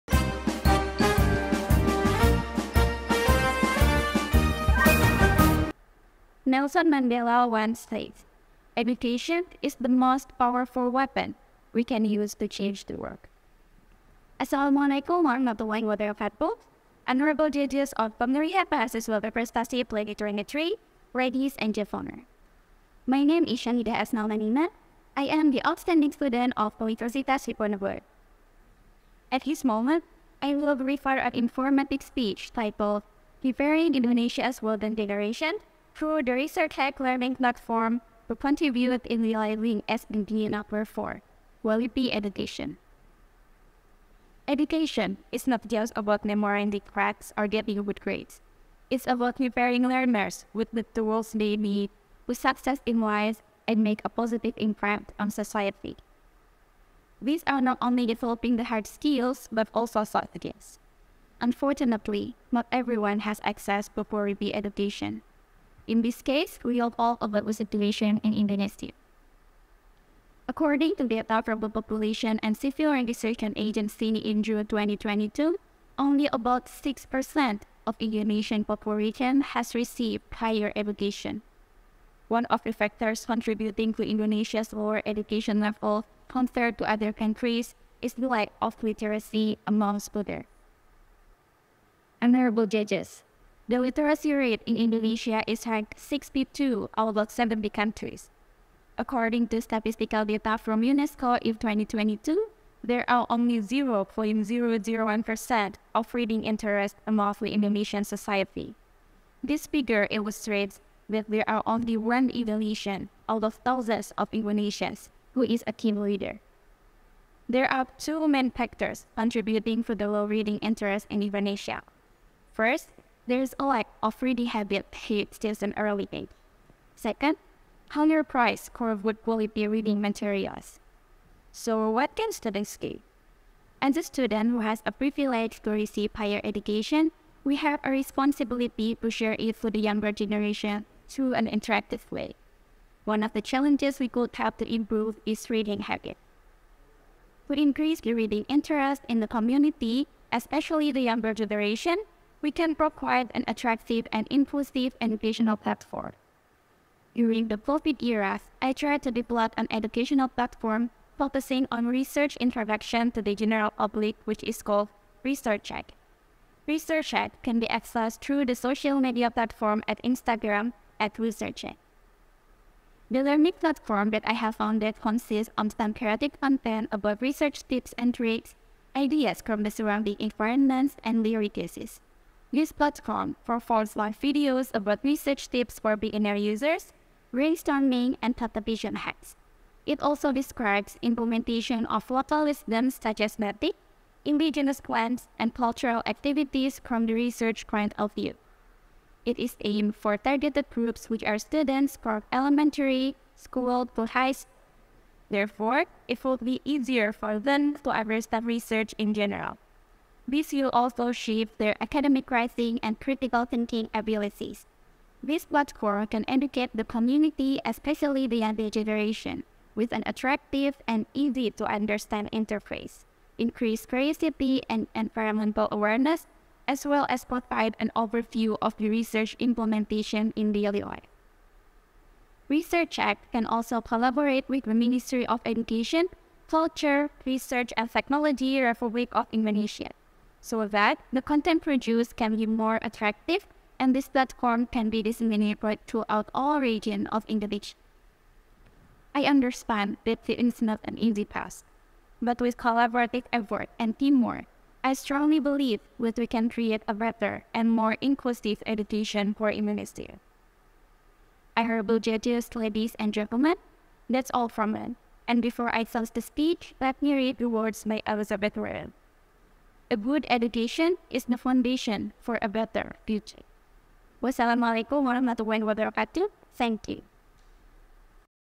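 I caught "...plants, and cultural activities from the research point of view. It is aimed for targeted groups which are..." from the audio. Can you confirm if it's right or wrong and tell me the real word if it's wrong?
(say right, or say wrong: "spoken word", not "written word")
right.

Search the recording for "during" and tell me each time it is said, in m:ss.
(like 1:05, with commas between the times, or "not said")
0:18, 2:37.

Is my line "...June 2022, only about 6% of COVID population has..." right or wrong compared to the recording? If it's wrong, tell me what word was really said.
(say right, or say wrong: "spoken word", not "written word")
wrong: "Indonesian", not "COVID".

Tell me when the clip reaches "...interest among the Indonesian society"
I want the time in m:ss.
1:46.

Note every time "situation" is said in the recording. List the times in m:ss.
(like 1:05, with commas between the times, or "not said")
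1:07.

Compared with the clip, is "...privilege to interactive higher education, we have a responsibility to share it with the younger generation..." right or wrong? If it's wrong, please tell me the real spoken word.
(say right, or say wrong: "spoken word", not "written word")
wrong: "receive", not "interactive".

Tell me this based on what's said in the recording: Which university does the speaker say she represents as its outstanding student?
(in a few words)
Universitas Diponegoro.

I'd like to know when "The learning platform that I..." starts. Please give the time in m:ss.
2:53.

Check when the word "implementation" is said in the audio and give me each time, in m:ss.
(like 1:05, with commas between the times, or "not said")
3:11, 3:49.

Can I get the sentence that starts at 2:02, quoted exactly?
First, there's a lack of reading habit paid since an early age.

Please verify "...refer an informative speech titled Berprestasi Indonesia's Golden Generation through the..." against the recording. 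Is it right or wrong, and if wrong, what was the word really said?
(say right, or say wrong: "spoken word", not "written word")
wrong: "Preparing", not "Berprestasi".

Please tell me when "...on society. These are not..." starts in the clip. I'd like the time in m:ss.
0:55.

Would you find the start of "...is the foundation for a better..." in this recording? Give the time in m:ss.
4:31.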